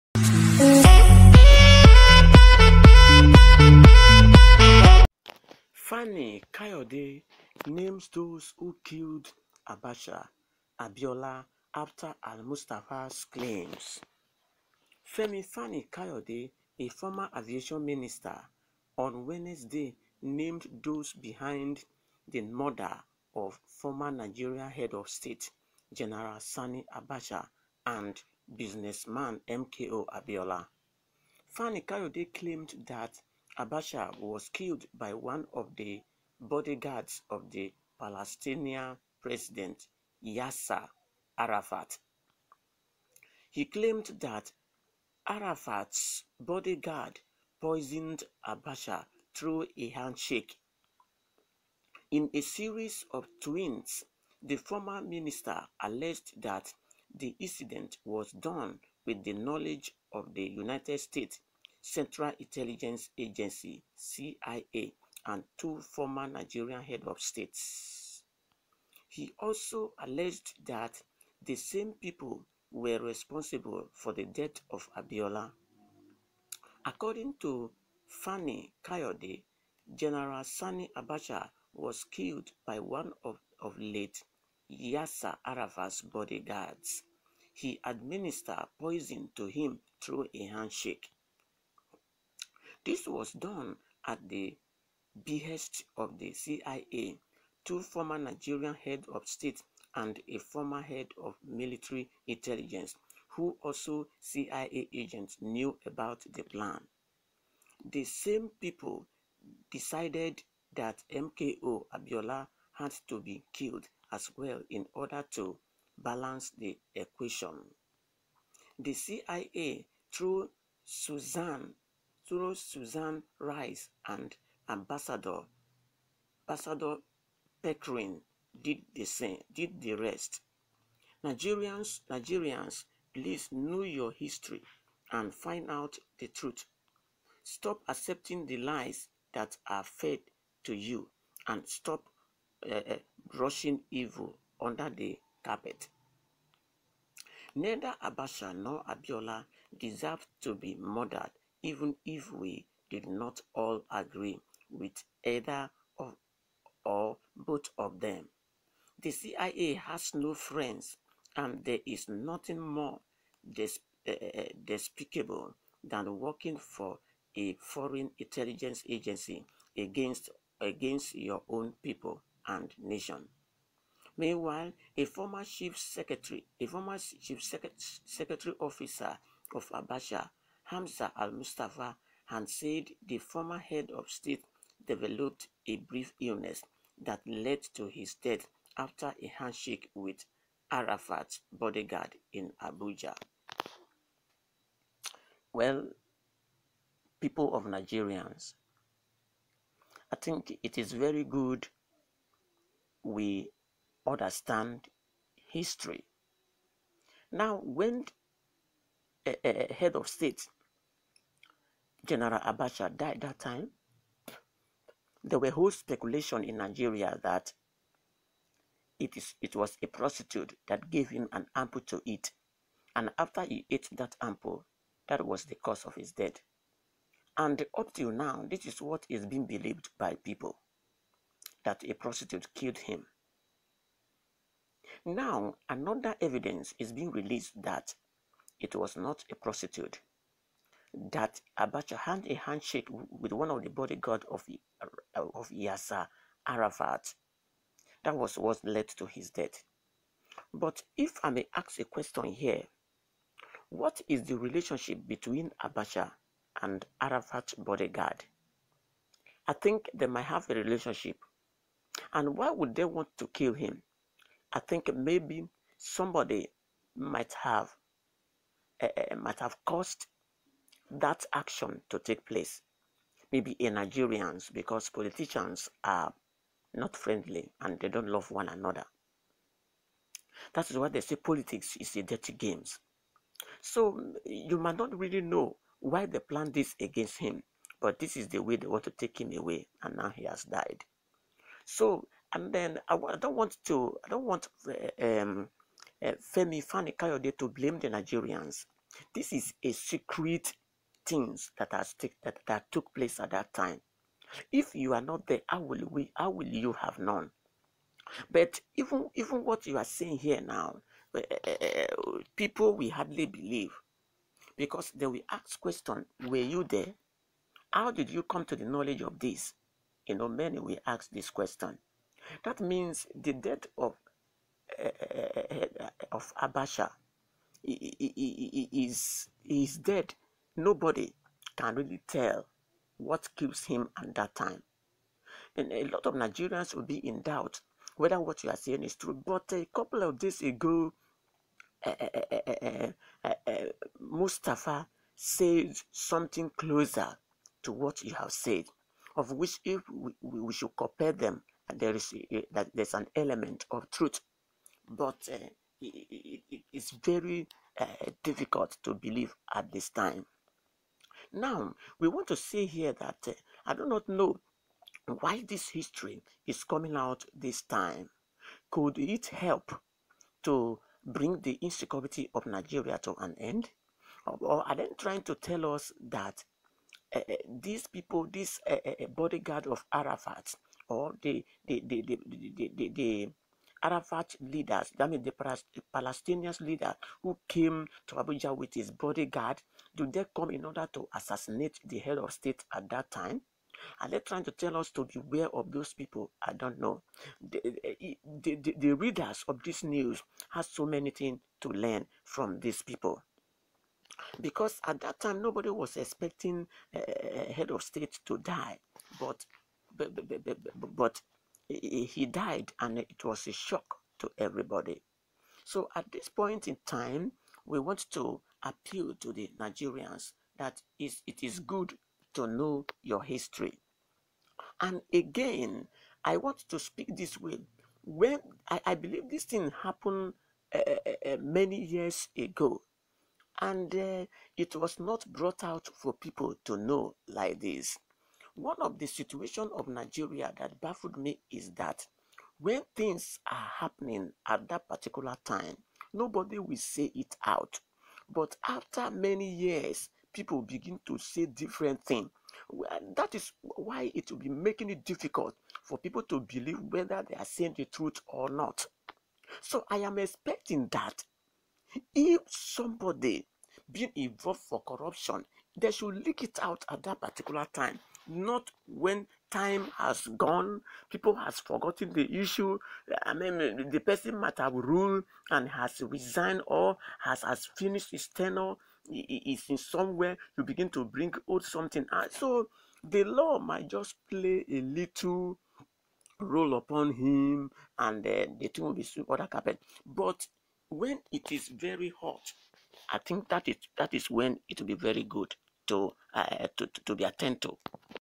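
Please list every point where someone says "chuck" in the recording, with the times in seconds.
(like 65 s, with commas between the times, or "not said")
not said.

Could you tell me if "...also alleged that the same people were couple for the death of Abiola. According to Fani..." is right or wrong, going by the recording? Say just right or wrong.
wrong.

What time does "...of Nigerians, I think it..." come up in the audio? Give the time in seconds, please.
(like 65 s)
197 s.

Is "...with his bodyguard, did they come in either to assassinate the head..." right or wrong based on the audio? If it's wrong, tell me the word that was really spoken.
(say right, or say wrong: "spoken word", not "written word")
wrong: "order", not "either".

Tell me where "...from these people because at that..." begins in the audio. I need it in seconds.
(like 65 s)
402 s.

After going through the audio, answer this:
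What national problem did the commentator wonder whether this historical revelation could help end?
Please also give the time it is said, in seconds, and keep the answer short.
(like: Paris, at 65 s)
insecurity, at 371 s.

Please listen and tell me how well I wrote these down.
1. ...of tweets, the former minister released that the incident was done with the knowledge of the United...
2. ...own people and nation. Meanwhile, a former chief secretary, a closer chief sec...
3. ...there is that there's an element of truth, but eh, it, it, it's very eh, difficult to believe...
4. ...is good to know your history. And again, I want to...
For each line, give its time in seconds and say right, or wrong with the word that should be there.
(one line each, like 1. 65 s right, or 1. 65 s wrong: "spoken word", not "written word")
1. 53 s wrong: "alleged", not "released"
2. 171 s wrong: "former", not "closer"
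3. 351 s right
4. 421 s right.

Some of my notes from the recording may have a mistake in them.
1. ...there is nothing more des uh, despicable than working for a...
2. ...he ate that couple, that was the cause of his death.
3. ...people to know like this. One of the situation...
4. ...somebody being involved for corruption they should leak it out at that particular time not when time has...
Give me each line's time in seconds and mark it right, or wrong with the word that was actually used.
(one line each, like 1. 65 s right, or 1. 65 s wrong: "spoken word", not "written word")
1. 161 s right
2. 223 s wrong: "ample", not "couple"
3. 436 s right
4. 462 s right.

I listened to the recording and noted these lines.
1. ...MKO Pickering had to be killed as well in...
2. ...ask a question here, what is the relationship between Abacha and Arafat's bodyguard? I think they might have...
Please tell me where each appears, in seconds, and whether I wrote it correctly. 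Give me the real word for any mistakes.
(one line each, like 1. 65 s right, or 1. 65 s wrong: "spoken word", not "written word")
1. 111 s wrong: "Abiola", not "Pickering"
2. 251 s right.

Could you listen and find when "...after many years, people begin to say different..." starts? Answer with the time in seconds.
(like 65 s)
448 s.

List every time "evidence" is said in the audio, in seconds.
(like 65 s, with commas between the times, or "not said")
236 s.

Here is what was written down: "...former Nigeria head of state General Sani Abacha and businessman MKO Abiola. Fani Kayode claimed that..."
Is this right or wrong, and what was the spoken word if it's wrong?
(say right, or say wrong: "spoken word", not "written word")
right.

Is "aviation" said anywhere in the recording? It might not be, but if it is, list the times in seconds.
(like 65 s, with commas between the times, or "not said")
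17 s.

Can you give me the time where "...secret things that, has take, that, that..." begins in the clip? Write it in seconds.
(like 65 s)
299 s.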